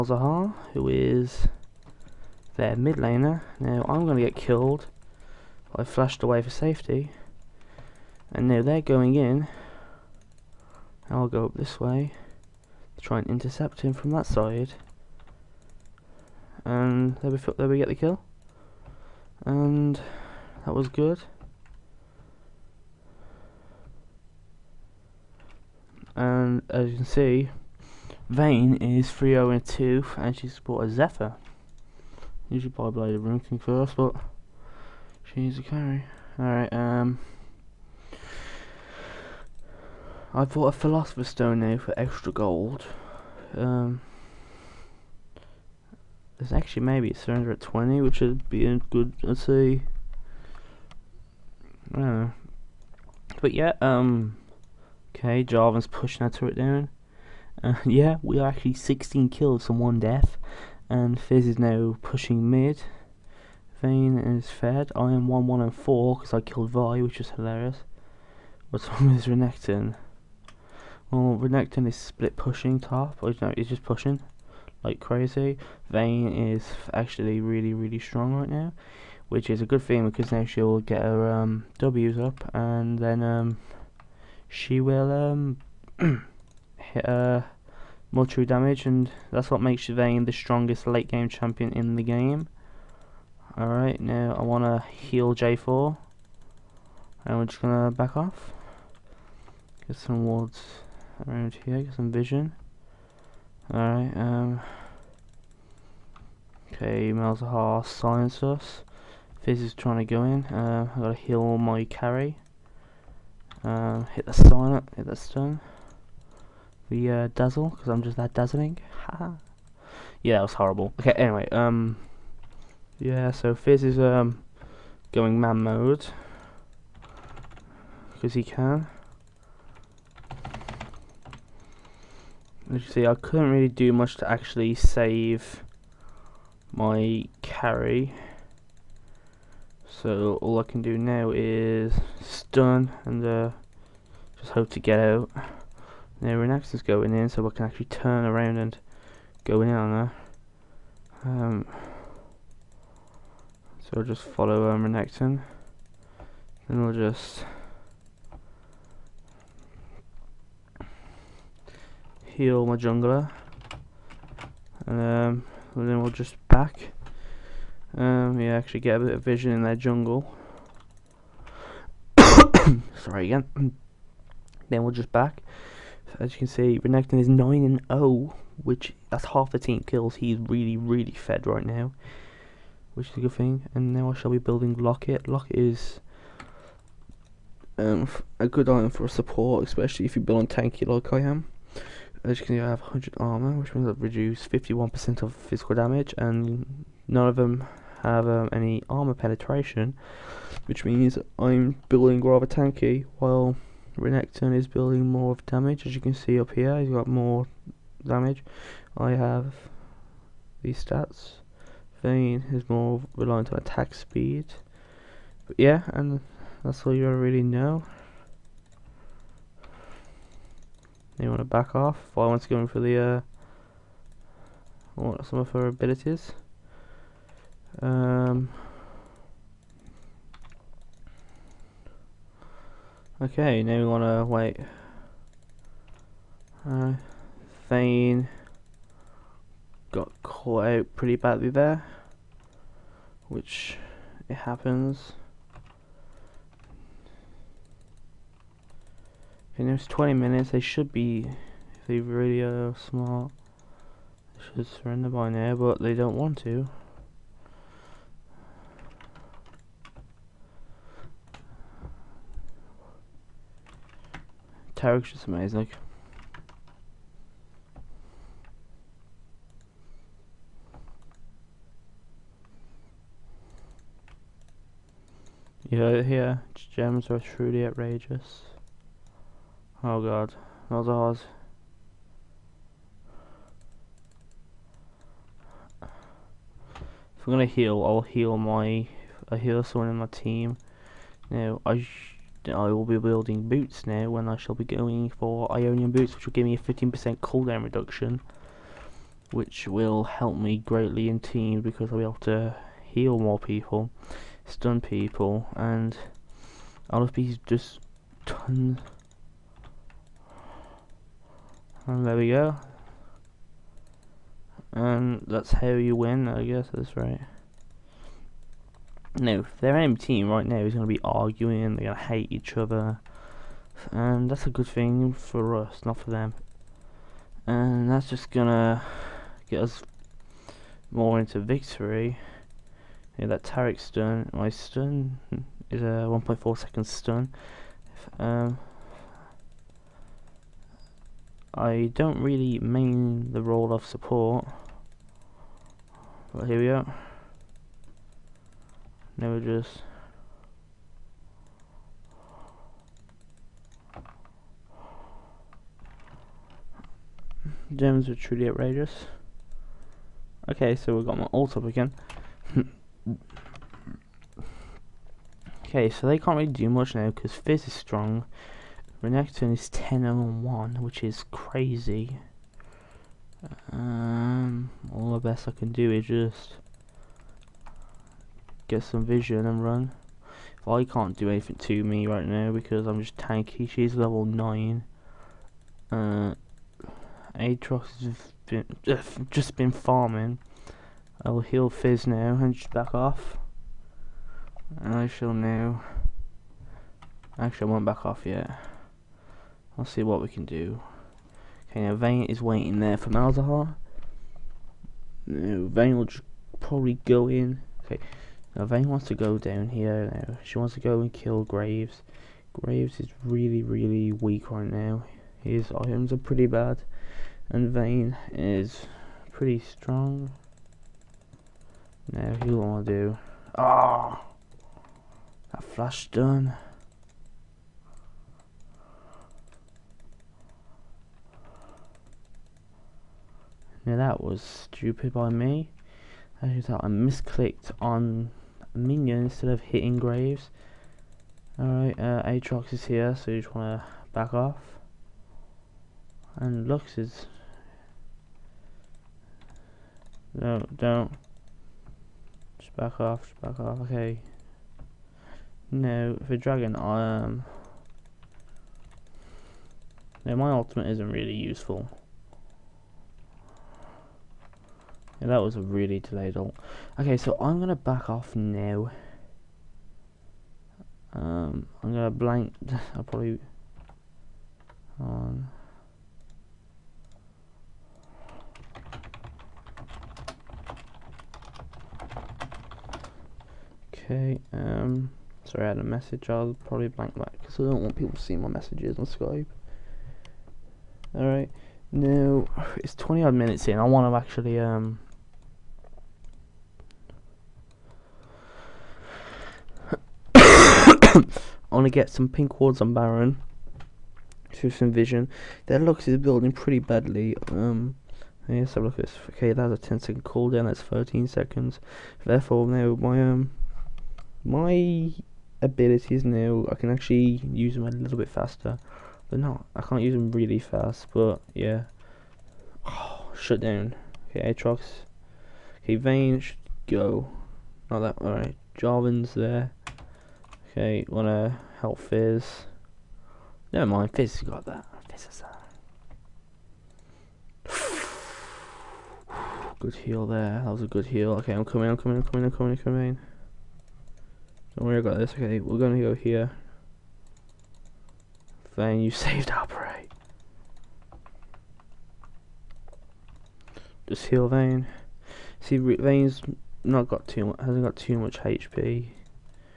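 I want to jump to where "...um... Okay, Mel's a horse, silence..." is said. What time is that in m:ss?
1:44.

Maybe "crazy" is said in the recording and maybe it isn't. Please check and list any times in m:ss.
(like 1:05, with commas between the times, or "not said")
1:14, 6:11.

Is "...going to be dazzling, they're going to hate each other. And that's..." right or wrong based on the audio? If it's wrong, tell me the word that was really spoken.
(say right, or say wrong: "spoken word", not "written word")
wrong: "arguing", not "dazzling".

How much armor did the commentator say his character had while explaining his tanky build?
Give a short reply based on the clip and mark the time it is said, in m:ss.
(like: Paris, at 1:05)
100, at 3:12.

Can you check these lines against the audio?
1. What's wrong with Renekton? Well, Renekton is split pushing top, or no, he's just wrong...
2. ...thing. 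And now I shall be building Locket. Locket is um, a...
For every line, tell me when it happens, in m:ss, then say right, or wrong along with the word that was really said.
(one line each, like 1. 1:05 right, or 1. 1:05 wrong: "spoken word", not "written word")
1. 1:08 wrong: "pushing", not "wrong"
2. 3:03 right.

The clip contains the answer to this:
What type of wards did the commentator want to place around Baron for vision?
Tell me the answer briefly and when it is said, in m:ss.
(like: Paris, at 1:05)
pink wards, at 8:22.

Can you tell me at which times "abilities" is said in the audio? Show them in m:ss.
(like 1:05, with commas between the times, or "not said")
3:45, 8:35.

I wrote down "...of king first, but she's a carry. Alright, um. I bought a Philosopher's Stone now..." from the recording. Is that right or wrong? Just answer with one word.
right.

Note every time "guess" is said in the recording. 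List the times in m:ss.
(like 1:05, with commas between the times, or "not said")
5:16.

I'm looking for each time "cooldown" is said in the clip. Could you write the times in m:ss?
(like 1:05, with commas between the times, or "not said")
4:57, 8:30.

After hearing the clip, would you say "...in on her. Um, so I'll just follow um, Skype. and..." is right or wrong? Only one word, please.
wrong.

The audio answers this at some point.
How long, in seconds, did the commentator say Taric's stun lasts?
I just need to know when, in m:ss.
5:36.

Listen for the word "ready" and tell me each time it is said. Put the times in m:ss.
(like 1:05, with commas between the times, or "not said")
not said.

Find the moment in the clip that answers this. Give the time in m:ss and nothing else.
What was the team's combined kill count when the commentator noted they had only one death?
0:58.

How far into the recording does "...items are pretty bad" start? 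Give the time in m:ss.
6:55.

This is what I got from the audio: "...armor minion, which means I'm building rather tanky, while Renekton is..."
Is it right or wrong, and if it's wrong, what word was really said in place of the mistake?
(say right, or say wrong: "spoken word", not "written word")
wrong: "penetration", not "minion".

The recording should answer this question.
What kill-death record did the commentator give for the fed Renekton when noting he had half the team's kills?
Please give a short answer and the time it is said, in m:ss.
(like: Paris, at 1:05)
9 and 0, at 2:57.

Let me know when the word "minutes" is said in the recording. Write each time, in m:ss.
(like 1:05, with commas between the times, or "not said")
4:10, 8:13.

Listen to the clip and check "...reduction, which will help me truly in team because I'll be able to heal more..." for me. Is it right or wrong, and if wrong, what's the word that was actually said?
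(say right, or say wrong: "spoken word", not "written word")
wrong: "greatly", not "truly".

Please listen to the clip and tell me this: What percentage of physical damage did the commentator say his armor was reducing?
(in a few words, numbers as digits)
51%.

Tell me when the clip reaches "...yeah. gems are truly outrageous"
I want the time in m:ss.
4:36.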